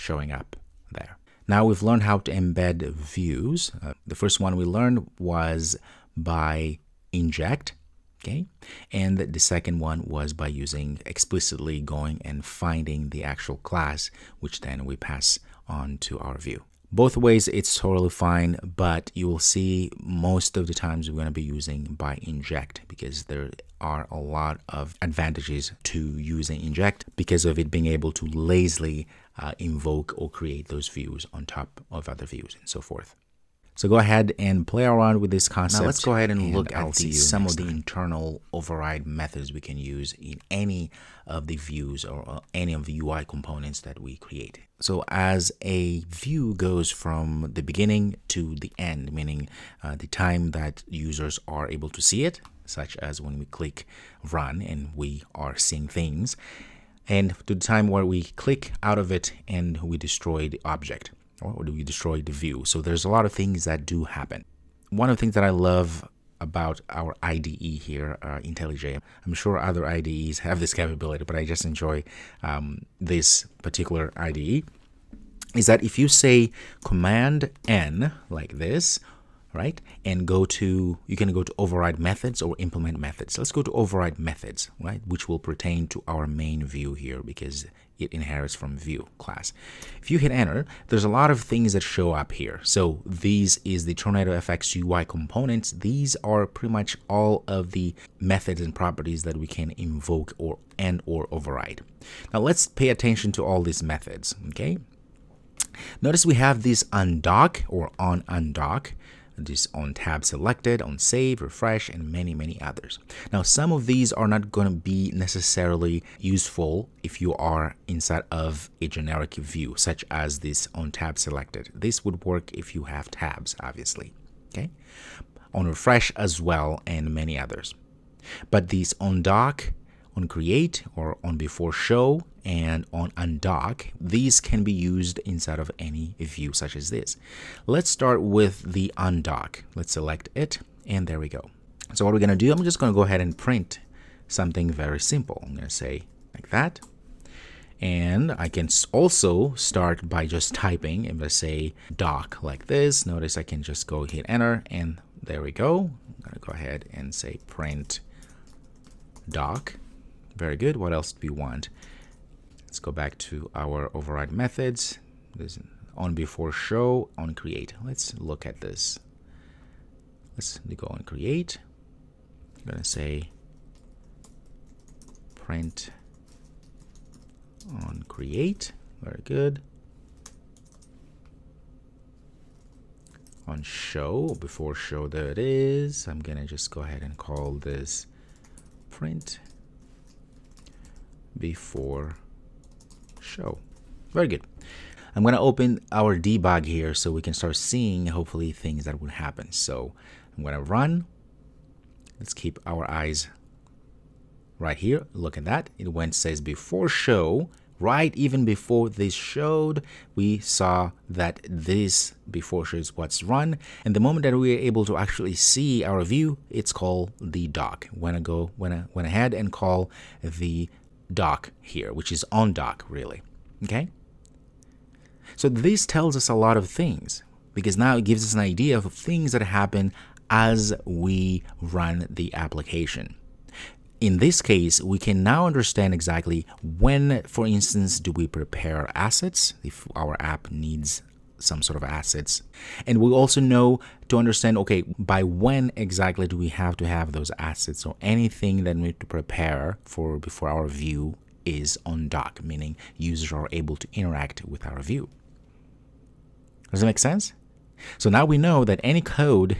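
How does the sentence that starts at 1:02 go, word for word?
So there's a lot of things that do happen.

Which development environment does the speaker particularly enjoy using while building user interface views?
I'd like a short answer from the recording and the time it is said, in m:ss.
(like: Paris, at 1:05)
IntelliJ, at 1:08.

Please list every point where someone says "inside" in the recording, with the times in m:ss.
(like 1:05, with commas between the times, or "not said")
1:57, 2:15.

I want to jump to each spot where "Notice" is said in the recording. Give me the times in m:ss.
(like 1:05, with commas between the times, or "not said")
1:46, 2:33.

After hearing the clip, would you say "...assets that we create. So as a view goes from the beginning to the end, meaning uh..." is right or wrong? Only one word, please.
wrong.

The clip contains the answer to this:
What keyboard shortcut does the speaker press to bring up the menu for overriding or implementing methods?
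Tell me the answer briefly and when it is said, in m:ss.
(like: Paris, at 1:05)
Command N, at 1:16.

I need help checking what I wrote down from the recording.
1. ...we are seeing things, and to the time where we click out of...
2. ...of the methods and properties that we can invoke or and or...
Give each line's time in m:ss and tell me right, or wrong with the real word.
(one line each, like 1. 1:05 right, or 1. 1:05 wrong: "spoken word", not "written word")
1. 0:54 right
2. 1:37 right.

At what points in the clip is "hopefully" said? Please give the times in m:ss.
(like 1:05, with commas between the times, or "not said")
3:18.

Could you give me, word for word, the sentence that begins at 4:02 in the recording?
And we also know to understand okay, by when exactly do we have to have those assets?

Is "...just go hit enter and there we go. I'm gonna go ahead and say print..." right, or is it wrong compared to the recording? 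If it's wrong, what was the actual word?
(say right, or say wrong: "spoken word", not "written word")
right.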